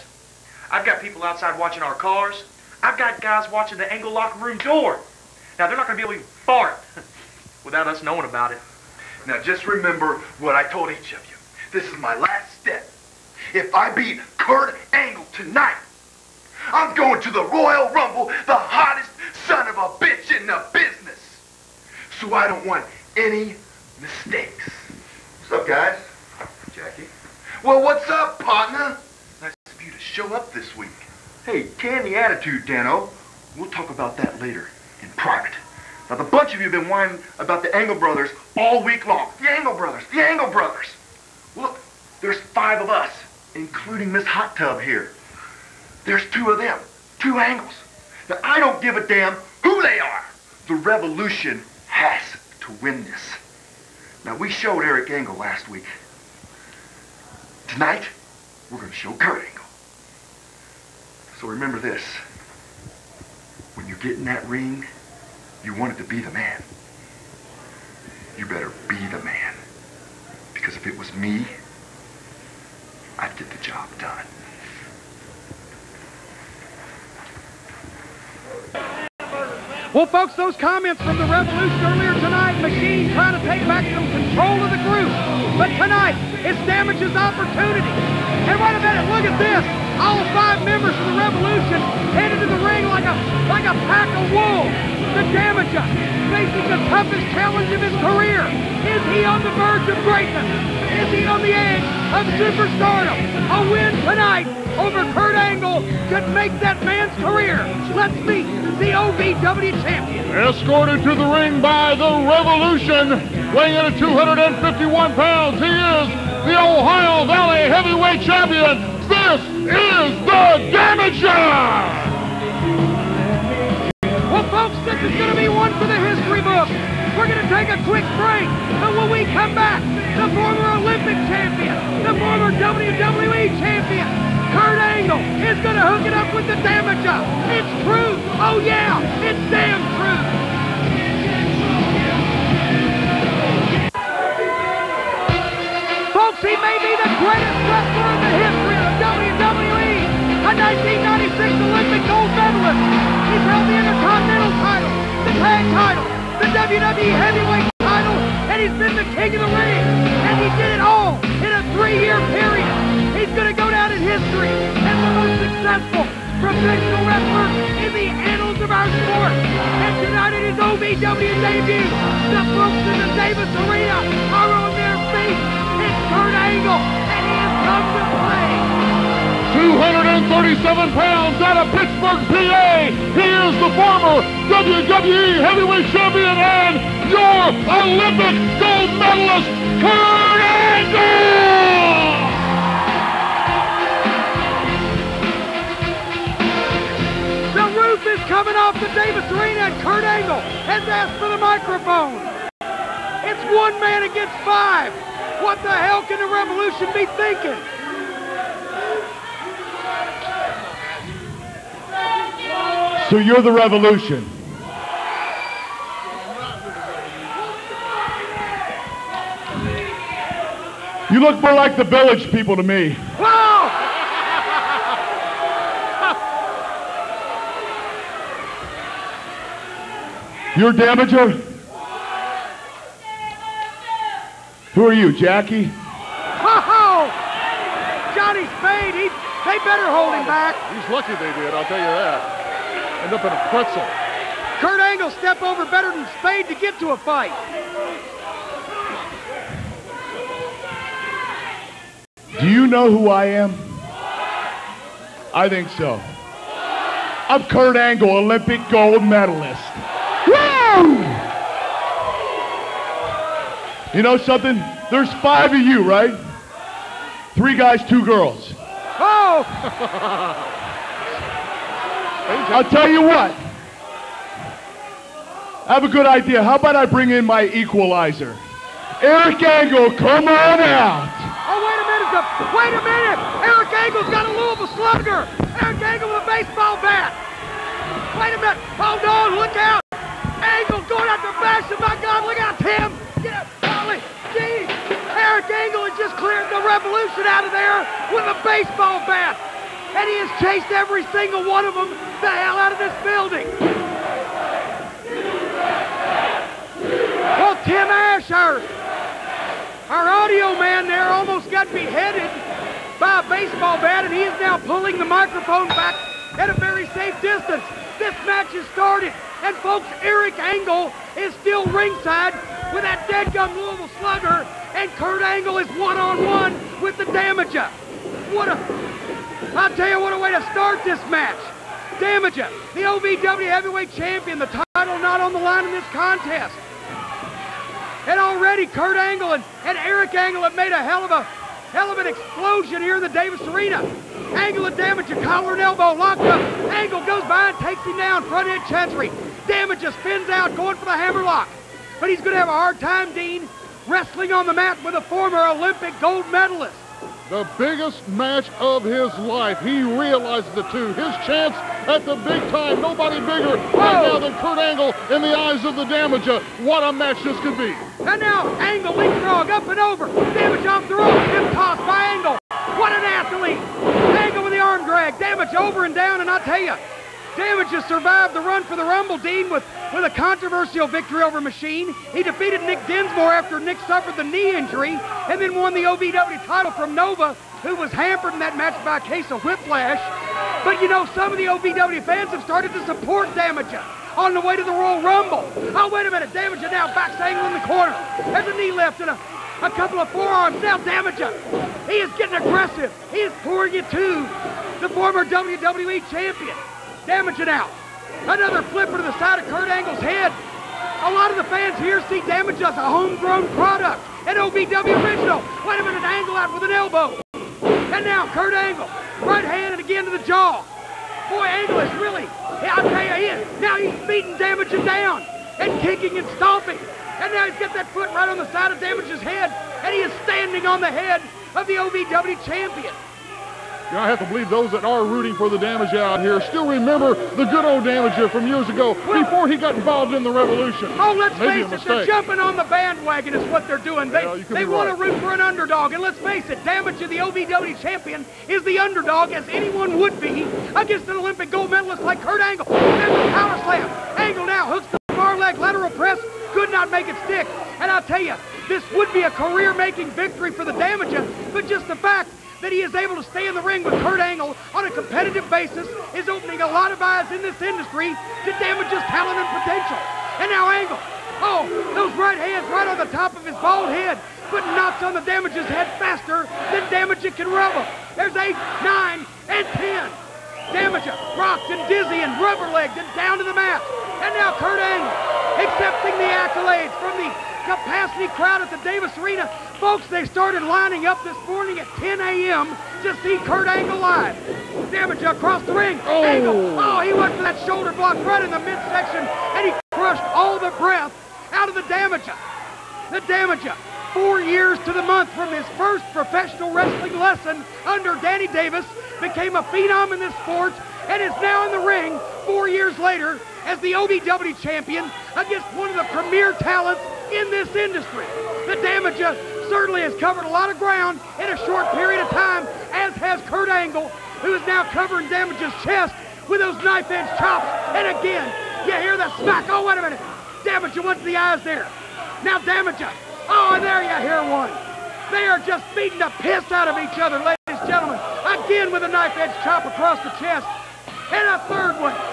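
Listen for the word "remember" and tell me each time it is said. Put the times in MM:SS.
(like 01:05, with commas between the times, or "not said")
00:09, 01:01, 07:16.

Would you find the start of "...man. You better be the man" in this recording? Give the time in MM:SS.
01:06.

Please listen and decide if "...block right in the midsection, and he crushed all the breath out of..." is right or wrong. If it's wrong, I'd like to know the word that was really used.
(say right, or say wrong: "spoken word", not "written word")
right.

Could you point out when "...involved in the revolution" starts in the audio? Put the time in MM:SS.
07:19.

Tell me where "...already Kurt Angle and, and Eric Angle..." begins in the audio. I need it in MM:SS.
05:38.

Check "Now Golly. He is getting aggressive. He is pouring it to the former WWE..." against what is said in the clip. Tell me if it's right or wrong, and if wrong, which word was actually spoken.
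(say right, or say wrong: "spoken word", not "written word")
wrong: "Damaja", not "Golly".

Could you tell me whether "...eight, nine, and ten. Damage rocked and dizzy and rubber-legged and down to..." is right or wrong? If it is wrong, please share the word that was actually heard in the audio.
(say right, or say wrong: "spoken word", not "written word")
right.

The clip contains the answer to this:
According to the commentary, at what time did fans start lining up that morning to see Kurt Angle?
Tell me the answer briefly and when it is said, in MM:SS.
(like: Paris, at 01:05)
10 a.m., at 08:11.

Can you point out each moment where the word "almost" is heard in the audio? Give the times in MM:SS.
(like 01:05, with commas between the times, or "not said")
05:11.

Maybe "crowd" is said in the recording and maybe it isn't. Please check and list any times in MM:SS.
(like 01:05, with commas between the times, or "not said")
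08:08.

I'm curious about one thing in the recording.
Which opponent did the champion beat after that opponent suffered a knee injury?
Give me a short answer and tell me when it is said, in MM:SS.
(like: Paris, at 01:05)
Nick Dinsmore, at 06:22.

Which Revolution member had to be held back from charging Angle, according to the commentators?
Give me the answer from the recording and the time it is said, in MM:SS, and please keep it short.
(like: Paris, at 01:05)
Johnny Spade, at 03:58.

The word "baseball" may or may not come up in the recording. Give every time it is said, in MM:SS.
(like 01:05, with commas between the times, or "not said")
04:46, 04:58, 05:13.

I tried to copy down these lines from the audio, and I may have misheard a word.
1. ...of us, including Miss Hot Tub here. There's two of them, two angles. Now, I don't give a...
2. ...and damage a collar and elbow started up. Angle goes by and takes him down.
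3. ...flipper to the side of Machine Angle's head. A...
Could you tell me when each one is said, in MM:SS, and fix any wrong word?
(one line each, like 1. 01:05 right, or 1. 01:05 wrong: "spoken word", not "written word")
1. 00:42 right
2. 05:44 wrong: "locked", not "started"
3. 06:48 wrong: "Kurt", not "Machine".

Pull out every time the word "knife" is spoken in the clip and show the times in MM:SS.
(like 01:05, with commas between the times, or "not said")
08:46, 08:59.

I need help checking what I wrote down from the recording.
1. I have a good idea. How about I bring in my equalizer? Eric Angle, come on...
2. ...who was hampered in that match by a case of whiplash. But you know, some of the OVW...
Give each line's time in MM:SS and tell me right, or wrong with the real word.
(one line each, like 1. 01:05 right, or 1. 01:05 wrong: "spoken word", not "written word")
1. 04:35 right
2. 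06:27 right.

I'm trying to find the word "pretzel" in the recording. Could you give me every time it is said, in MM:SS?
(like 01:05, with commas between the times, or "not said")
04:03.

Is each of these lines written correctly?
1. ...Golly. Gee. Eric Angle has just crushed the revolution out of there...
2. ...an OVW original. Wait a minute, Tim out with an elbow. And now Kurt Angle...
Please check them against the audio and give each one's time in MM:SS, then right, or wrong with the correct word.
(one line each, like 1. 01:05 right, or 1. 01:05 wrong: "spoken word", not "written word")
1. 04:53 wrong: "cleared", not "crushed"
2. 06:54 wrong: "Angle", not "Tim".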